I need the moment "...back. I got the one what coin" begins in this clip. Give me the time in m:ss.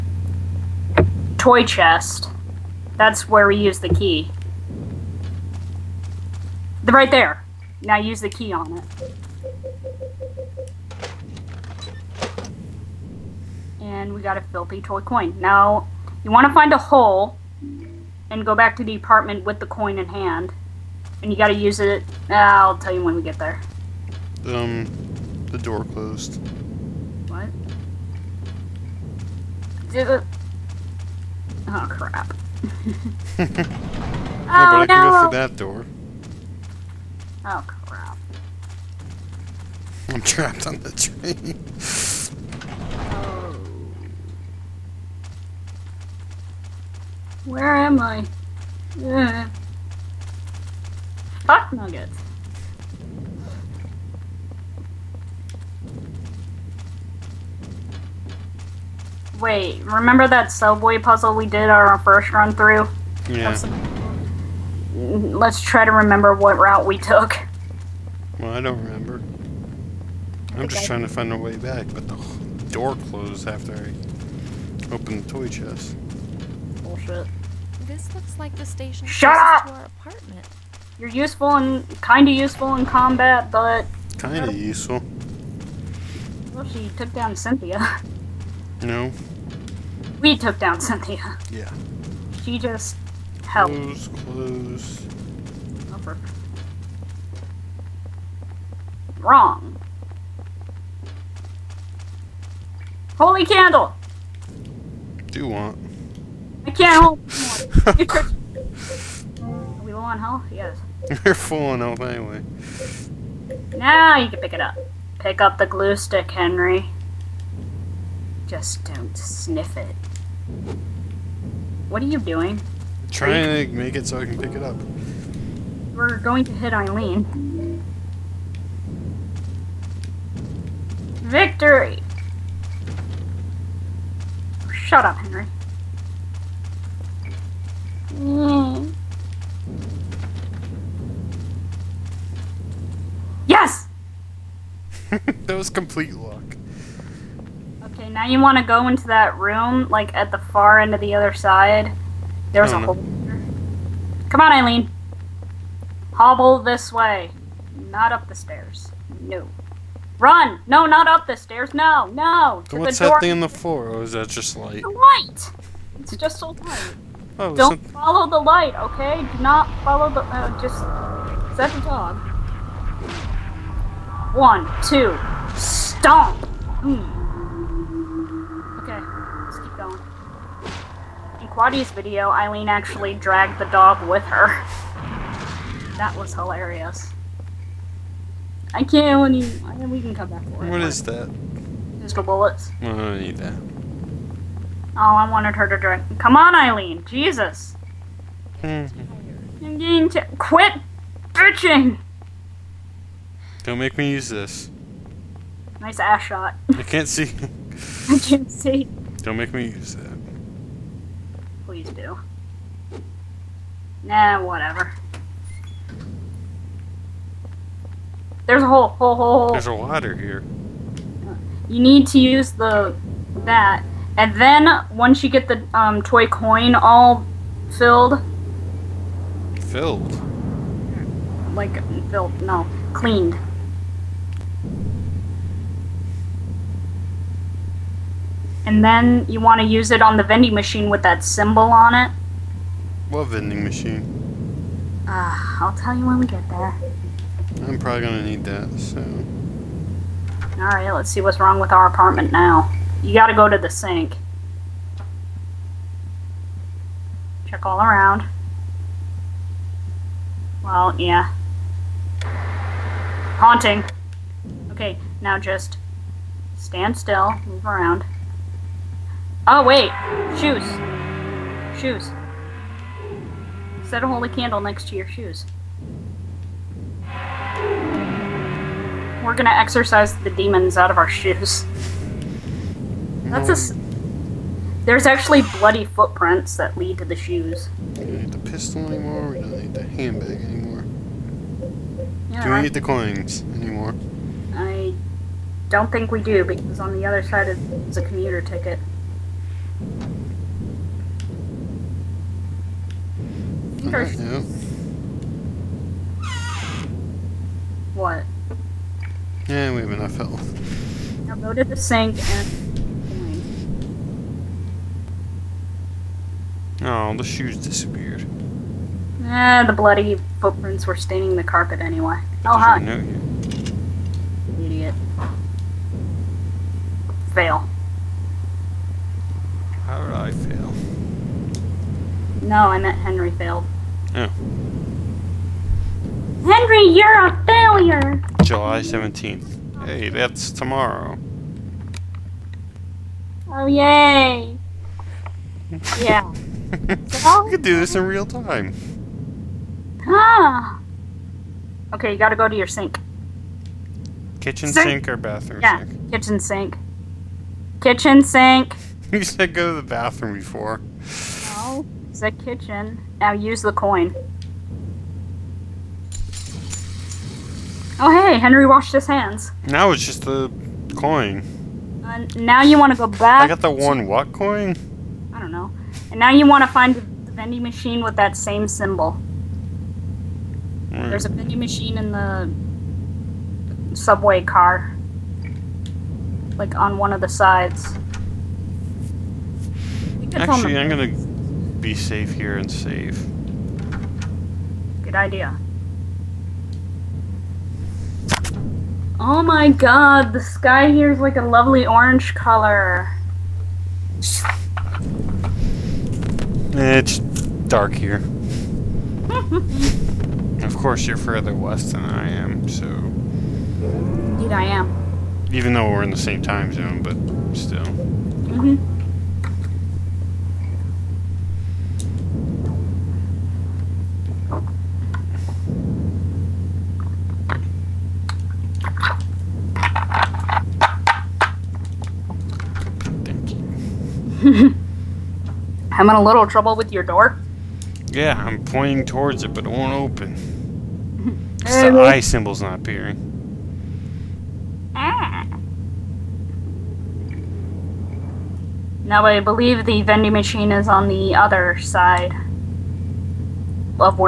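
6:13.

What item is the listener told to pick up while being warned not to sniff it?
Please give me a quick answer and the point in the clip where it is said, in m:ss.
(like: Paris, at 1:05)
Glue stick, at 1:55.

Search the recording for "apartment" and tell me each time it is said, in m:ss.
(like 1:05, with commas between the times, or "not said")
0:18, 1:19, 4:11.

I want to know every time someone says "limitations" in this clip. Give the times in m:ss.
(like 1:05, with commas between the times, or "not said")
not said.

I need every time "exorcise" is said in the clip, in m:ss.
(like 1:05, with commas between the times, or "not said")
4:39.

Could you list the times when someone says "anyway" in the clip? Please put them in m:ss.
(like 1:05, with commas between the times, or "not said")
1:51, 5:21.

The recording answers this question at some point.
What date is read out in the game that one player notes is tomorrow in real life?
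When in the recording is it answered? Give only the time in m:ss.
5:38.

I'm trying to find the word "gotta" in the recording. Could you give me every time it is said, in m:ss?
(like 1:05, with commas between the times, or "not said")
4:13, 5:52.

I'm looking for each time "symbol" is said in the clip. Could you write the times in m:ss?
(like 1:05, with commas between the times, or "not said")
4:01, 6:18, 7:22.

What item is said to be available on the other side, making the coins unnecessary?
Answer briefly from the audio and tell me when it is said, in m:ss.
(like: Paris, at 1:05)
Commuter ticket, at 4:58.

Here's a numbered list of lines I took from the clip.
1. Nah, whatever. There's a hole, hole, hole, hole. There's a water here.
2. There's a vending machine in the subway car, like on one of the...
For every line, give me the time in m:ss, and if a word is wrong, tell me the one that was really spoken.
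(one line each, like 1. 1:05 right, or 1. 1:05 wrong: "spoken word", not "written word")
1. 3:34 right
2. 6:21 right.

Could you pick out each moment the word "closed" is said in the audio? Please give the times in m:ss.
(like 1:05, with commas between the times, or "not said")
0:25, 1:13.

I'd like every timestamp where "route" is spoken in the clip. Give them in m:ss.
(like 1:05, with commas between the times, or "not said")
1:06.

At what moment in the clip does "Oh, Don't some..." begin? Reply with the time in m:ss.
2:47.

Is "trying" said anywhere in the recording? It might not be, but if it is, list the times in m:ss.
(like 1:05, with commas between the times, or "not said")
1:10, 2:03.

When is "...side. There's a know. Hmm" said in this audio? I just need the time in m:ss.
2:31.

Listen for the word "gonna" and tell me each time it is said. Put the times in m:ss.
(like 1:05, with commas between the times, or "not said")
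4:08, 4:39, 6:30.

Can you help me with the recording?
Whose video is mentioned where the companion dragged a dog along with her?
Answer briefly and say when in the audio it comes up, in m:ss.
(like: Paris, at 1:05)
Quadi, at 3:01.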